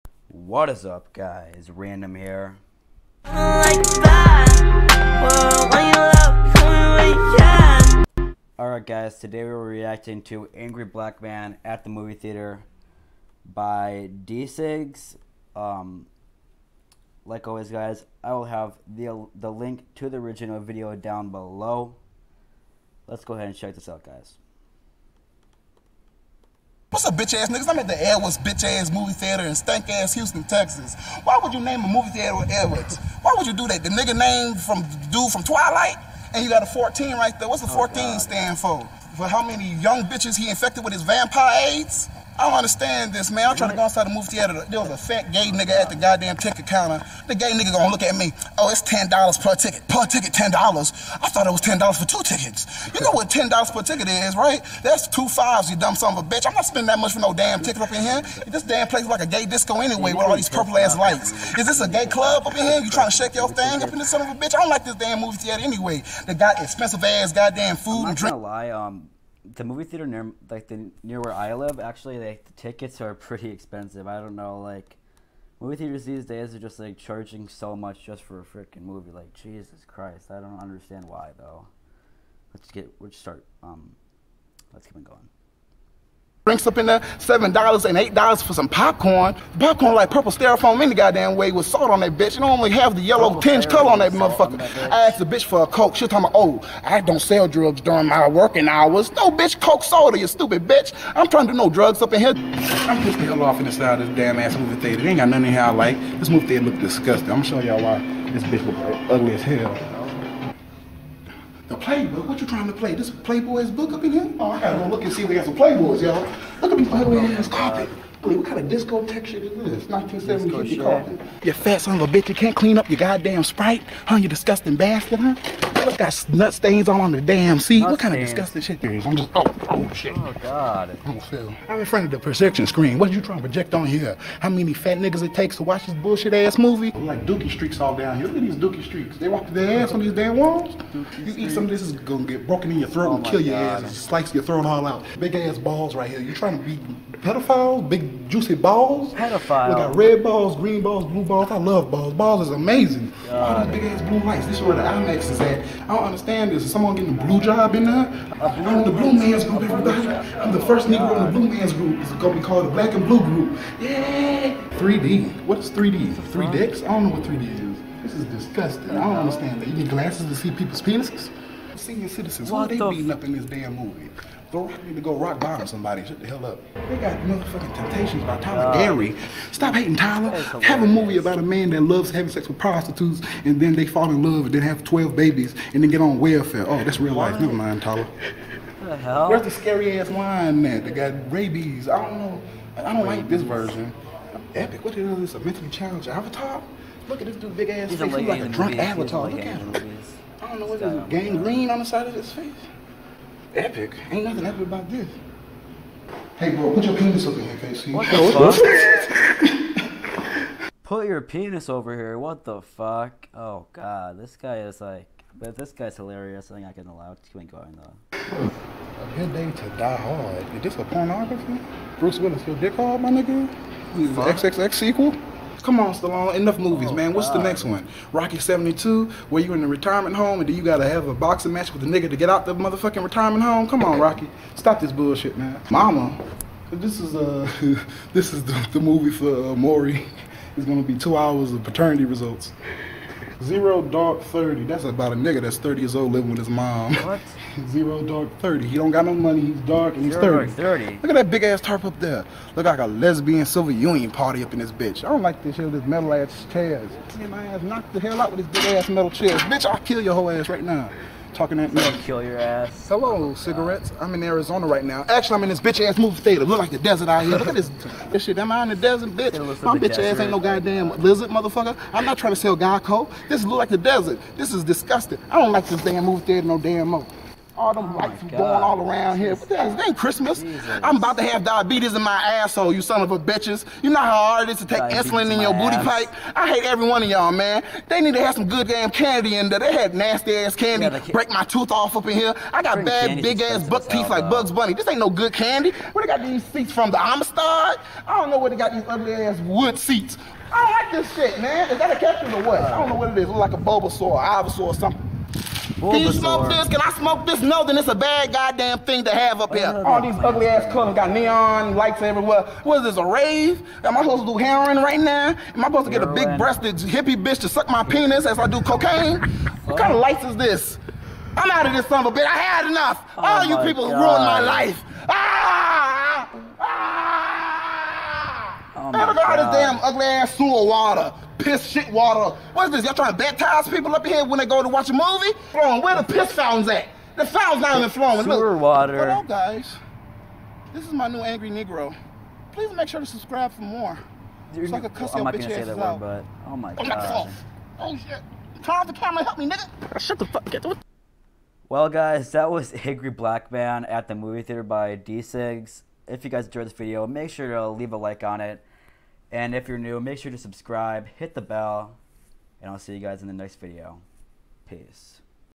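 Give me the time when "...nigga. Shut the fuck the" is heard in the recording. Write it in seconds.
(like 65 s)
349 s.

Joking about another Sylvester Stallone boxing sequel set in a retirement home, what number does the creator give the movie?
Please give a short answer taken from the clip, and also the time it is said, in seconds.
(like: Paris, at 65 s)
72, at 228 s.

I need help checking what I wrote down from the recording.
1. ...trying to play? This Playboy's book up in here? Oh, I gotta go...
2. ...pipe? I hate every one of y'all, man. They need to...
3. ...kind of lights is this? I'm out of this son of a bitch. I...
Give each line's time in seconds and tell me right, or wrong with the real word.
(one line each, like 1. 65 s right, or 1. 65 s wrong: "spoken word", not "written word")
1. 112 s right
2. 286 s right
3. 319 s right.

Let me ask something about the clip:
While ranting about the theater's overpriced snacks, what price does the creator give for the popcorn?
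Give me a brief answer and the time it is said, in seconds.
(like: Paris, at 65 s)
$8, at 87 s.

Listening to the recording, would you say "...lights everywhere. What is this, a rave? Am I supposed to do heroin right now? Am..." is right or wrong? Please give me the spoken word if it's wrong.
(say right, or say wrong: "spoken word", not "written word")
right.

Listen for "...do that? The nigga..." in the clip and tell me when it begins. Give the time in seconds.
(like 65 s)
33 s.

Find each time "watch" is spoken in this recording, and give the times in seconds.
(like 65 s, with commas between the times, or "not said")
135 s, 334 s.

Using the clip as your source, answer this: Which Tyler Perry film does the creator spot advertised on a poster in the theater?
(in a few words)
Temptations.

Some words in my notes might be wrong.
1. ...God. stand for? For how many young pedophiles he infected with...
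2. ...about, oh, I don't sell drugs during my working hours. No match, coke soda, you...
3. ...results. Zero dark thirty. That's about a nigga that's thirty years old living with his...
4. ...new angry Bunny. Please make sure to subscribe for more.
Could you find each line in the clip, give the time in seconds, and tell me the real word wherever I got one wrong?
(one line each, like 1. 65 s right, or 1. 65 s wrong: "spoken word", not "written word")
1. 37 s wrong: "bitches", not "pedophiles"
2. 96 s wrong: "bitch", not "match"
3. 242 s right
4. 341 s wrong: "Negro", not "Bunny".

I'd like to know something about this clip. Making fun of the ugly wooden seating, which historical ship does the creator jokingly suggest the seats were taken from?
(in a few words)
The Amistad.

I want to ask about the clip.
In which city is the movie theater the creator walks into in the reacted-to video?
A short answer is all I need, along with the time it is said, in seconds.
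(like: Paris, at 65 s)
Houston, at 30 s.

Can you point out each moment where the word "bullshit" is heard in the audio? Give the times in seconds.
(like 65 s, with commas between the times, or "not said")
135 s, 234 s.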